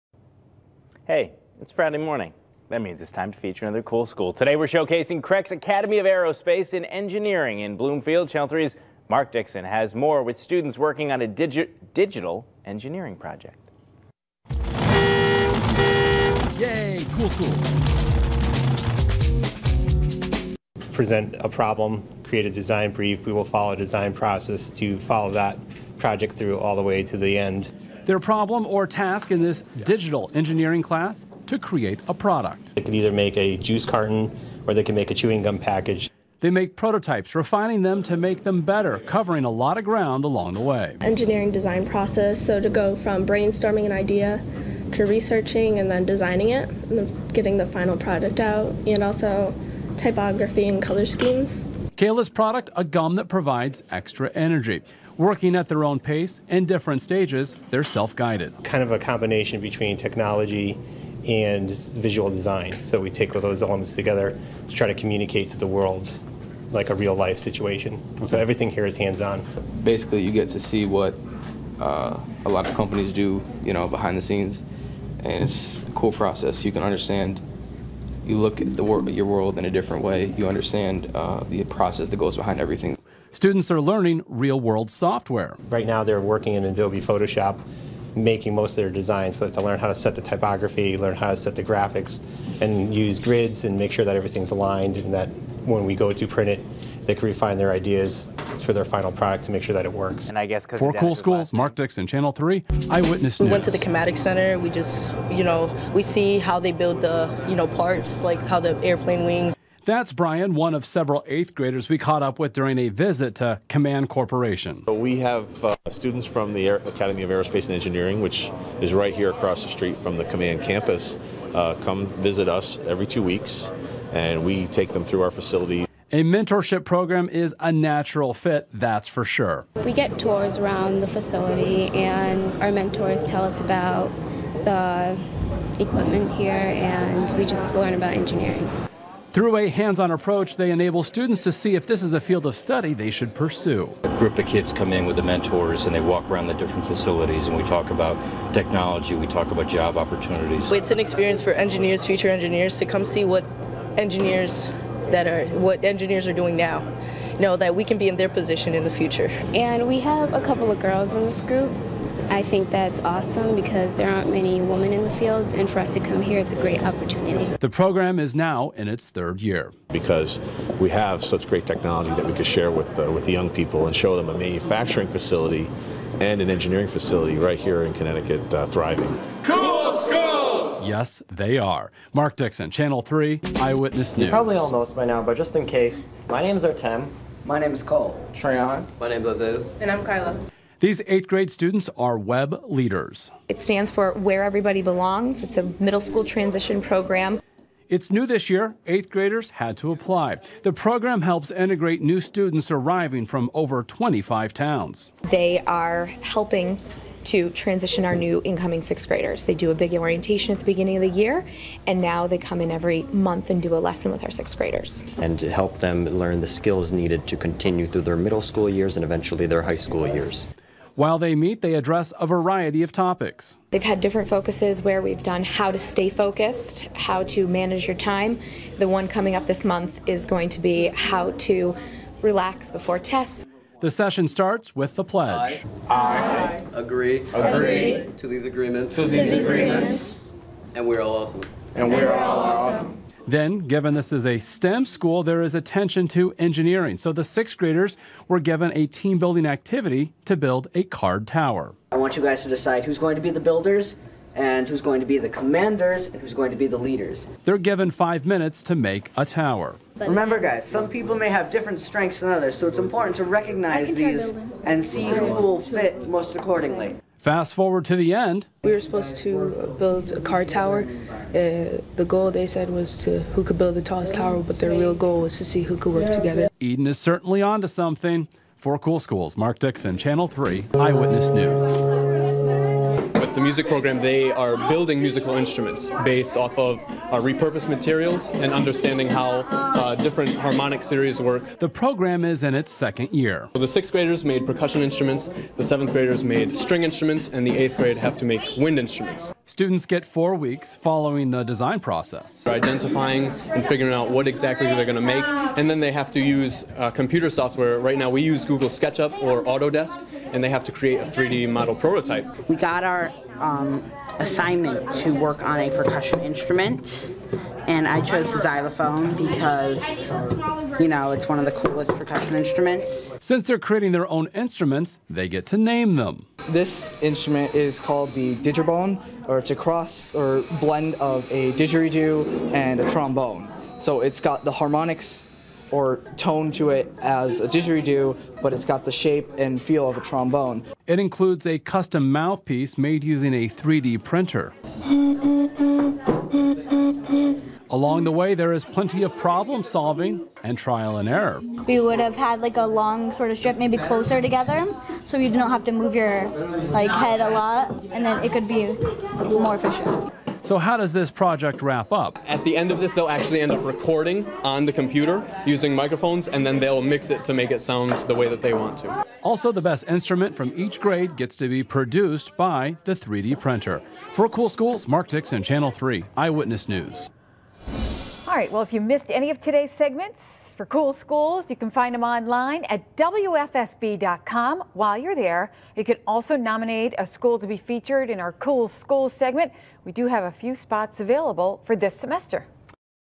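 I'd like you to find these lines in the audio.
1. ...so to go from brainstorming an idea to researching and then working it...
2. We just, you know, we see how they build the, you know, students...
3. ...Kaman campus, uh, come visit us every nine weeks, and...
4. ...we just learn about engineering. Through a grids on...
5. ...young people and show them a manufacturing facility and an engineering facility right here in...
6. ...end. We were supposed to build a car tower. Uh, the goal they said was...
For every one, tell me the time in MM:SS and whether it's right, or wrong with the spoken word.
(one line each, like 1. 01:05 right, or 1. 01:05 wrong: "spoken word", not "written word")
1. 00:42 wrong: "designing", not "working"
2. 01:44 wrong: "parts", not "students"
3. 02:00 wrong: "two", not "nine"
4. 02:17 wrong: "hands", not "grids"
5. 02:53 right
6. 04:28 right.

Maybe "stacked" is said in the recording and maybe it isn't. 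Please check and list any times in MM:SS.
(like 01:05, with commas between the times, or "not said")
not said.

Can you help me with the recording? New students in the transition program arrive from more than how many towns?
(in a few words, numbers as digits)
25.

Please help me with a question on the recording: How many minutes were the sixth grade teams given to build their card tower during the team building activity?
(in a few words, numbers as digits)
5.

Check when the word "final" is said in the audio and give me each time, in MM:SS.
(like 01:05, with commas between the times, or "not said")
00:47, 01:38.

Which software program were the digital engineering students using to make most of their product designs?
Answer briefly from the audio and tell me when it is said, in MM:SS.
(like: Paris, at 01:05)
Adobe Photoshop, at 01:26.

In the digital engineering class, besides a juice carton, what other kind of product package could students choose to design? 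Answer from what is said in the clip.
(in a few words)
Chewing gum package.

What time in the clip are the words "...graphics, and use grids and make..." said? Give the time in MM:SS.
01:31.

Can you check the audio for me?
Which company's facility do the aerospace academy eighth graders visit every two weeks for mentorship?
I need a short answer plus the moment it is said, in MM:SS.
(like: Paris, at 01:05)
Kaman Corporation, at 01:53.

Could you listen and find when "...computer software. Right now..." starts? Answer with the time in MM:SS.
05:06.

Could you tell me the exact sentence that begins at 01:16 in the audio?
You can understand you look at the wor your world in a different way.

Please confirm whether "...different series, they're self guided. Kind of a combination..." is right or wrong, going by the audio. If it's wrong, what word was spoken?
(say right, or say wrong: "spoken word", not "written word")
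wrong: "stages", not "series".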